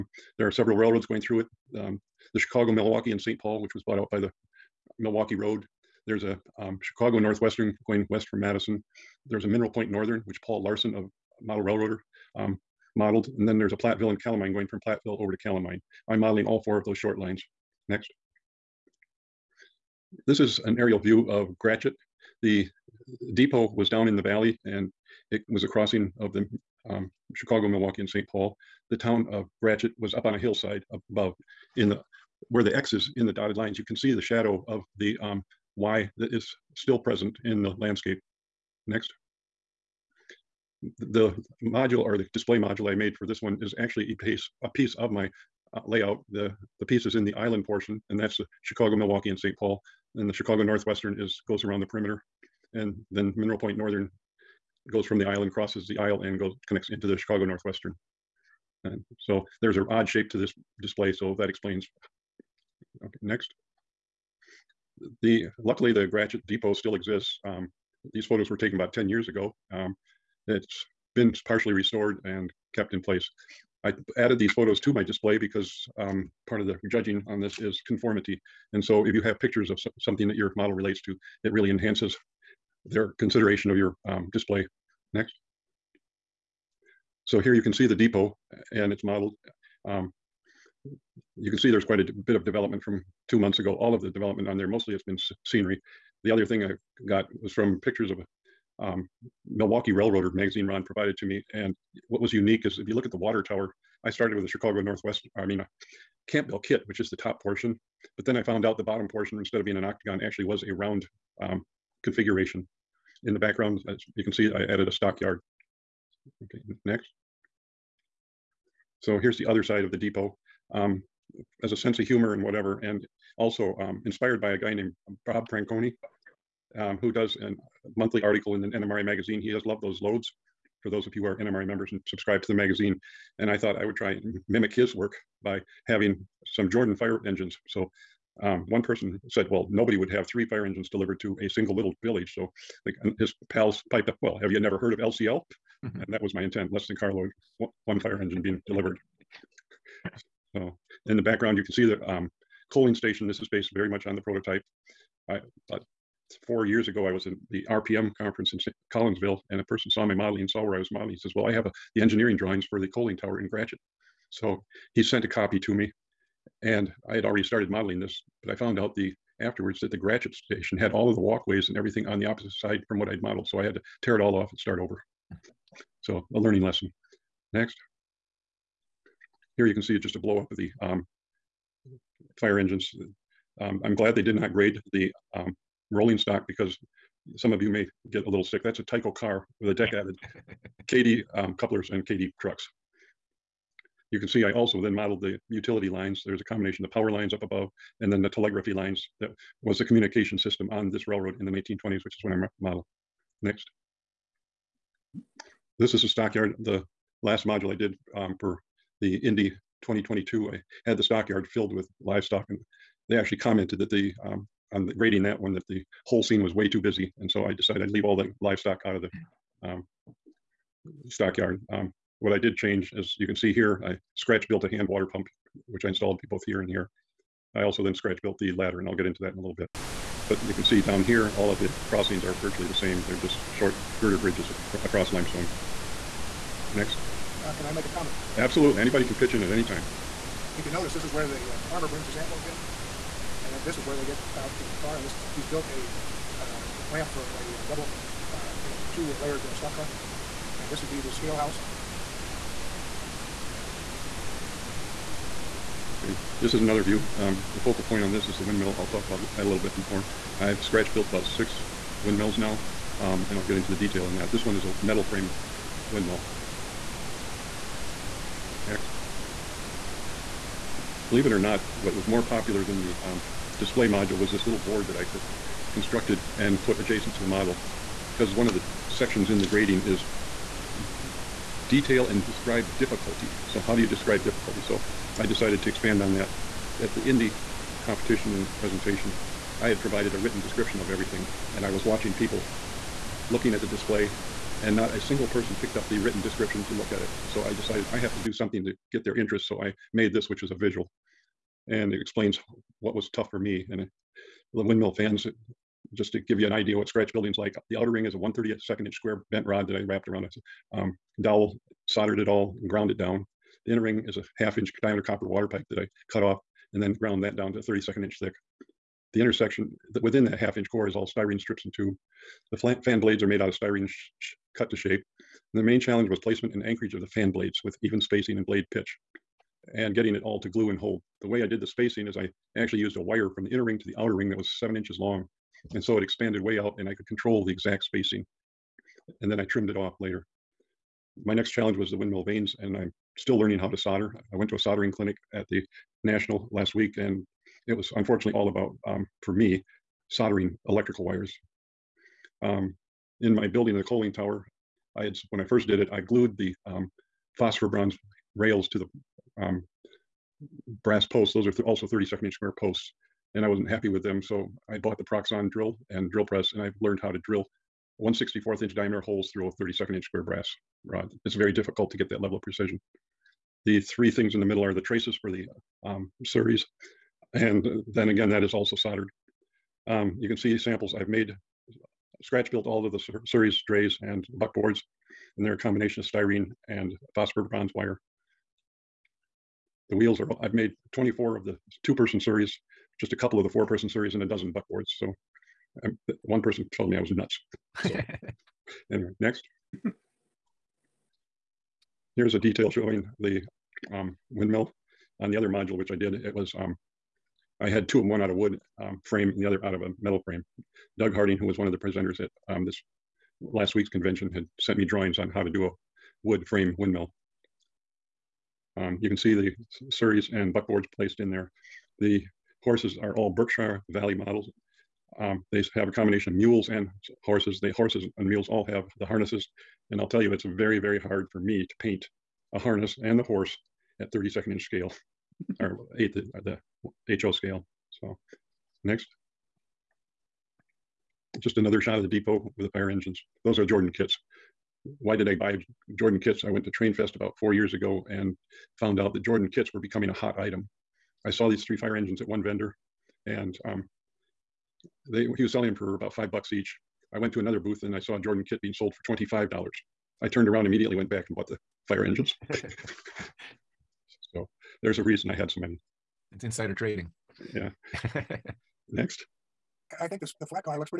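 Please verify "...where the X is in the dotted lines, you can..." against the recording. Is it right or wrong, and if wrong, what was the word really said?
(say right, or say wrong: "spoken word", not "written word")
right.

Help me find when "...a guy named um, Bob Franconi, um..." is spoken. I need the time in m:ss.
2:04.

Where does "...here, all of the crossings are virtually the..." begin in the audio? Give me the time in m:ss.
3:51.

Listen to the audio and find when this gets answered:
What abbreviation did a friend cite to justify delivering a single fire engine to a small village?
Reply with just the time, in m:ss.
2:24.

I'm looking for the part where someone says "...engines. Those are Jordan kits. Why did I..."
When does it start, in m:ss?
7:22.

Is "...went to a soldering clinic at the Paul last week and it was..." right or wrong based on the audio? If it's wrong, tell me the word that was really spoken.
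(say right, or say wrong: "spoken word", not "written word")
wrong: "National", not "Paul".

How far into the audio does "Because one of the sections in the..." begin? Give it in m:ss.
4:38.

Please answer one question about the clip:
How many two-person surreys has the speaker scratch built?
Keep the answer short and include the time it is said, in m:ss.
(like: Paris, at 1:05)
24, at 6:30.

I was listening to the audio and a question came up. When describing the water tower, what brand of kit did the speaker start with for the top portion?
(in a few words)
Campbell.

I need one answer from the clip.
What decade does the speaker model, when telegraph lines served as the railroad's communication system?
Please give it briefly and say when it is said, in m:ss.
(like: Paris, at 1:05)
1920s, at 3:21.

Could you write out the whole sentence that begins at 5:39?
And then I trimmed it off later.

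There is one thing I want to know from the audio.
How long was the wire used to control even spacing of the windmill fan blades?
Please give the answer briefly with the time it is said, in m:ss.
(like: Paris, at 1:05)
7 inches, at 5:34.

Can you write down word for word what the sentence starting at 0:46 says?
The, the piece is in the island portion, and that's the Chicago, Milwaukee, and St.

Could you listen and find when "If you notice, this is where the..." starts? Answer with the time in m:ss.
4:00.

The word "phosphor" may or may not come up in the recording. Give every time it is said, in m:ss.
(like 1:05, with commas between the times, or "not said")
5:57, 6:27.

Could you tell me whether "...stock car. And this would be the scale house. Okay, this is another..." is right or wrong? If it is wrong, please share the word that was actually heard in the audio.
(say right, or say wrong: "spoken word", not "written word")
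right.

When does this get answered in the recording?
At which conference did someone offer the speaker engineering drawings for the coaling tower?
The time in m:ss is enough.
2:38.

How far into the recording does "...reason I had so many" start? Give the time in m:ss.
7:45.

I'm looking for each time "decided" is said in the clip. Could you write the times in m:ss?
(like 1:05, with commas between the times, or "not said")
3:37, 4:45, 4:57.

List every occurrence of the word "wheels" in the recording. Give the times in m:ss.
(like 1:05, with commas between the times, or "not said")
6:29.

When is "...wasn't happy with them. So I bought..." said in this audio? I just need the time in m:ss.
6:03.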